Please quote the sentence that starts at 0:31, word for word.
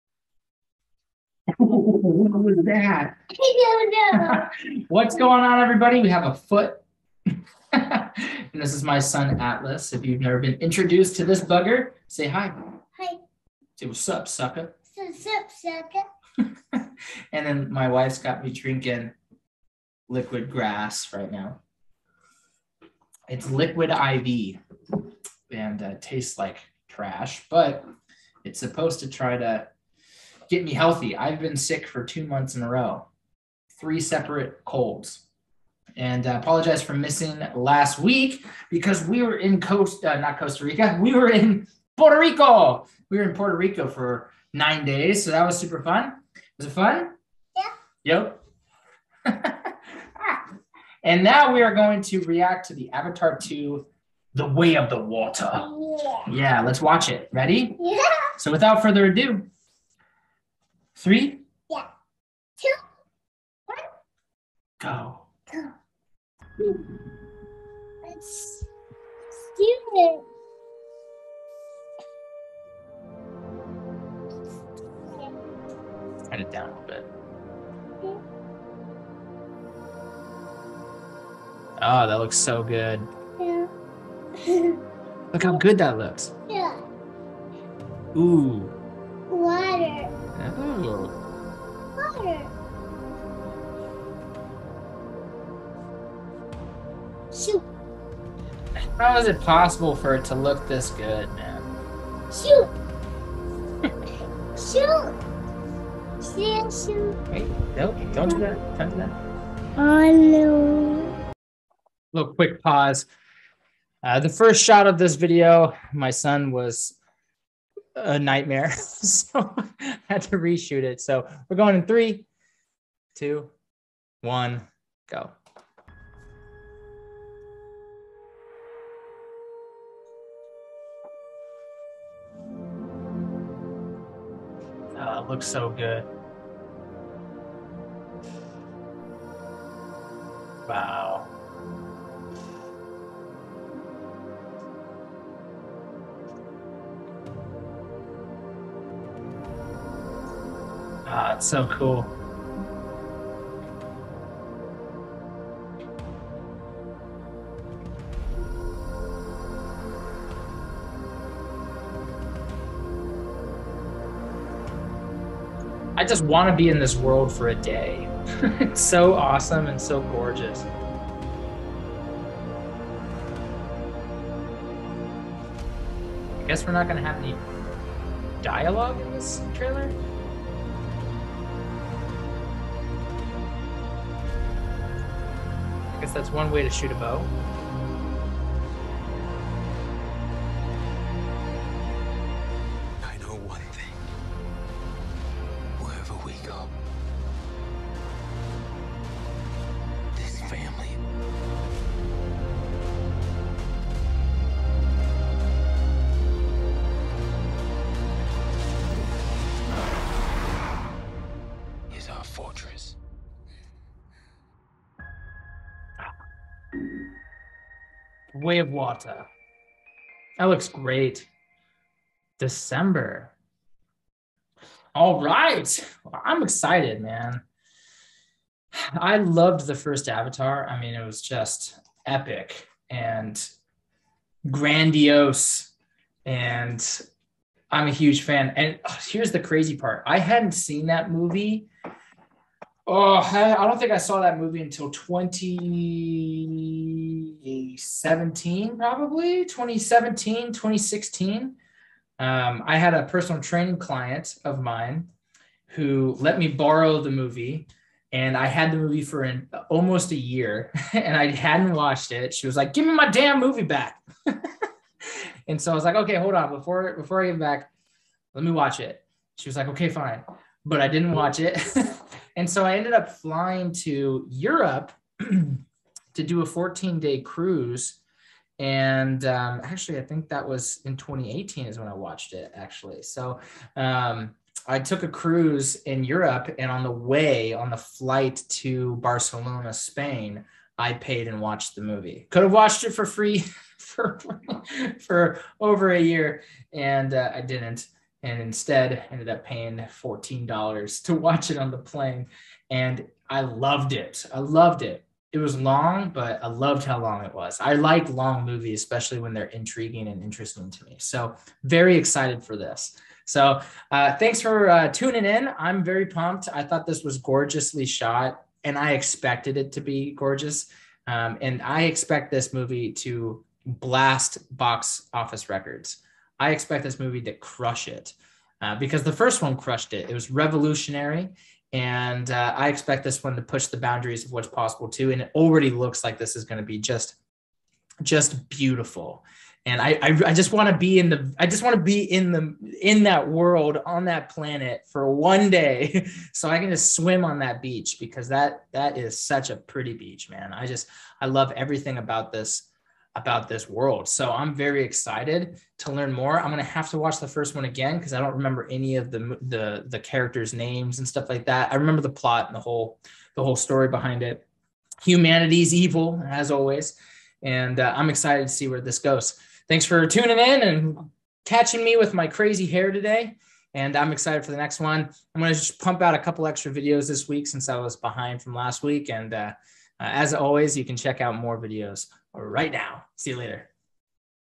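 I've been sick for two months in a row, three separate colds.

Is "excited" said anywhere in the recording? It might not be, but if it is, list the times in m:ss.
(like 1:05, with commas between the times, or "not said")
3:46, 5:11, 5:54, 6:08, 6:14.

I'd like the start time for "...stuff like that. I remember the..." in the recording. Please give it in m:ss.
6:01.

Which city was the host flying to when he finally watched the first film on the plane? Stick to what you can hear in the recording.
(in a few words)
Barcelona.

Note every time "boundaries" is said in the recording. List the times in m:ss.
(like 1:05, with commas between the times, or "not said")
5:33.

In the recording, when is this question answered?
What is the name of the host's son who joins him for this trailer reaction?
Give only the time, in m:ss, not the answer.
0:09.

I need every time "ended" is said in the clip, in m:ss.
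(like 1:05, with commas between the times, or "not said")
4:32, 4:59.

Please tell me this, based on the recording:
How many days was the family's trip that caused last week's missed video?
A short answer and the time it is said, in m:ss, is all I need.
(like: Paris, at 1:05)
9, at 0:44.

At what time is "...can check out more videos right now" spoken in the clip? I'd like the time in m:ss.
6:20.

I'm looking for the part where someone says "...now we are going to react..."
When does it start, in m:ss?
0:51.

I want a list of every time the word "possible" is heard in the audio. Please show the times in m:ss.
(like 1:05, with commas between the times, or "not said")
1:39, 5:34.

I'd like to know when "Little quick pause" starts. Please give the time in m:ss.
1:52.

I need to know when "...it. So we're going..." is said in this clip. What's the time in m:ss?
2:00.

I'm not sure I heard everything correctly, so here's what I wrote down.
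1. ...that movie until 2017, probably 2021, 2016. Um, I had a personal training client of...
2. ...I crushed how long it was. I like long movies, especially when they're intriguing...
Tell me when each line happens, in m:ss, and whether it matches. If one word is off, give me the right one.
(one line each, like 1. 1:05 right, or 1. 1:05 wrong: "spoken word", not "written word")
1. 4:04 wrong: "2017", not "2021"
2. 5:06 wrong: "loved", not "crushed".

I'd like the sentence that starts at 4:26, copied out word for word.
Before, before I get back, let me watch it.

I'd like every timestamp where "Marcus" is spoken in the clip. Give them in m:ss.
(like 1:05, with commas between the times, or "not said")
not said.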